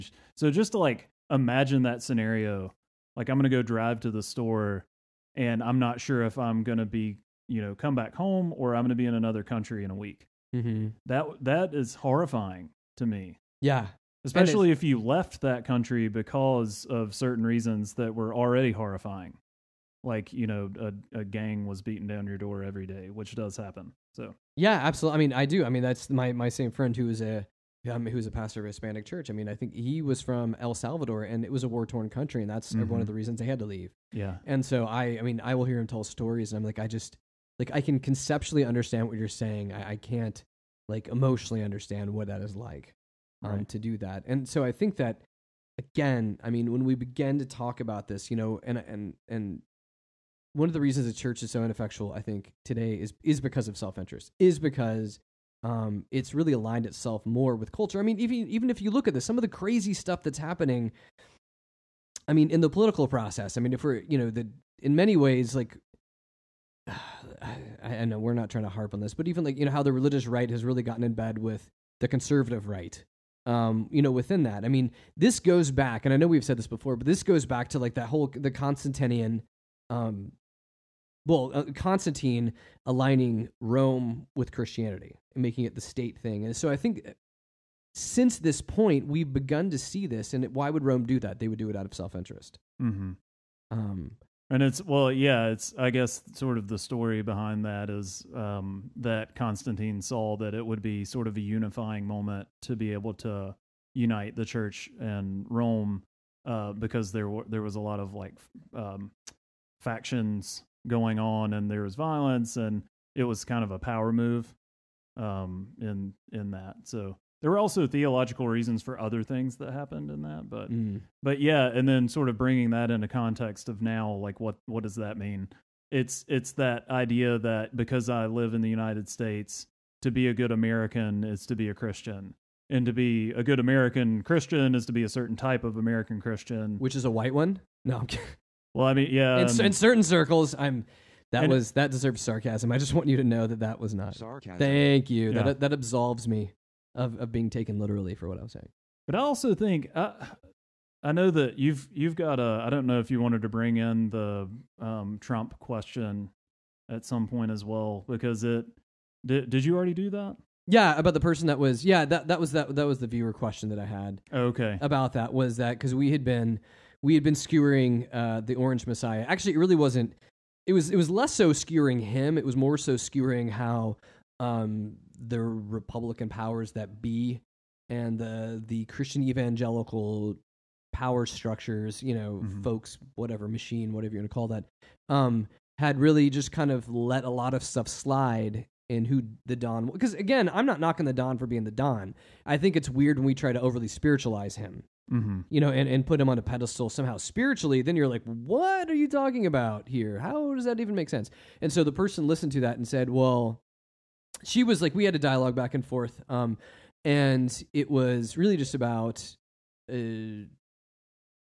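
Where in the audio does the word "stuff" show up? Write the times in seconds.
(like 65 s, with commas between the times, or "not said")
59 s, 187 s.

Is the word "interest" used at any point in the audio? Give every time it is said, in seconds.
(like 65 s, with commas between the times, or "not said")
53 s, 92 s.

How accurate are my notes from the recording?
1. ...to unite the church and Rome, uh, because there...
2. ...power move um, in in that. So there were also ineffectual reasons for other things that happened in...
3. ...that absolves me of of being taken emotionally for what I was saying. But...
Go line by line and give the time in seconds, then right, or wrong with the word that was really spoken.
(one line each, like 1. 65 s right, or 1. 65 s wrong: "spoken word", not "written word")
1. 103 s right
2. 113 s wrong: "theological", not "ineffectual"
3. 145 s wrong: "literally", not "emotionally".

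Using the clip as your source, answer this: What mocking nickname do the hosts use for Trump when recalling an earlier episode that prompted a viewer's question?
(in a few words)
the Orange Messiah.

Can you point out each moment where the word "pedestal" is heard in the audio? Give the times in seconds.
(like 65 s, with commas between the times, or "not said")
196 s.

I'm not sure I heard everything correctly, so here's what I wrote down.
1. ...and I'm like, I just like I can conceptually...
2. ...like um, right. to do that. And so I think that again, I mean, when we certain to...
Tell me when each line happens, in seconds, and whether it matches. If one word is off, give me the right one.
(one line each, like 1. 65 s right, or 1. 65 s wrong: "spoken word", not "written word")
1. 36 s right
2. 42 s wrong: "begin", not "certain".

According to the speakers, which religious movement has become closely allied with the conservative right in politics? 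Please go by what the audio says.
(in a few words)
the religious right.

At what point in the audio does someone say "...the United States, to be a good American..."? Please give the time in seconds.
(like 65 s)
128 s.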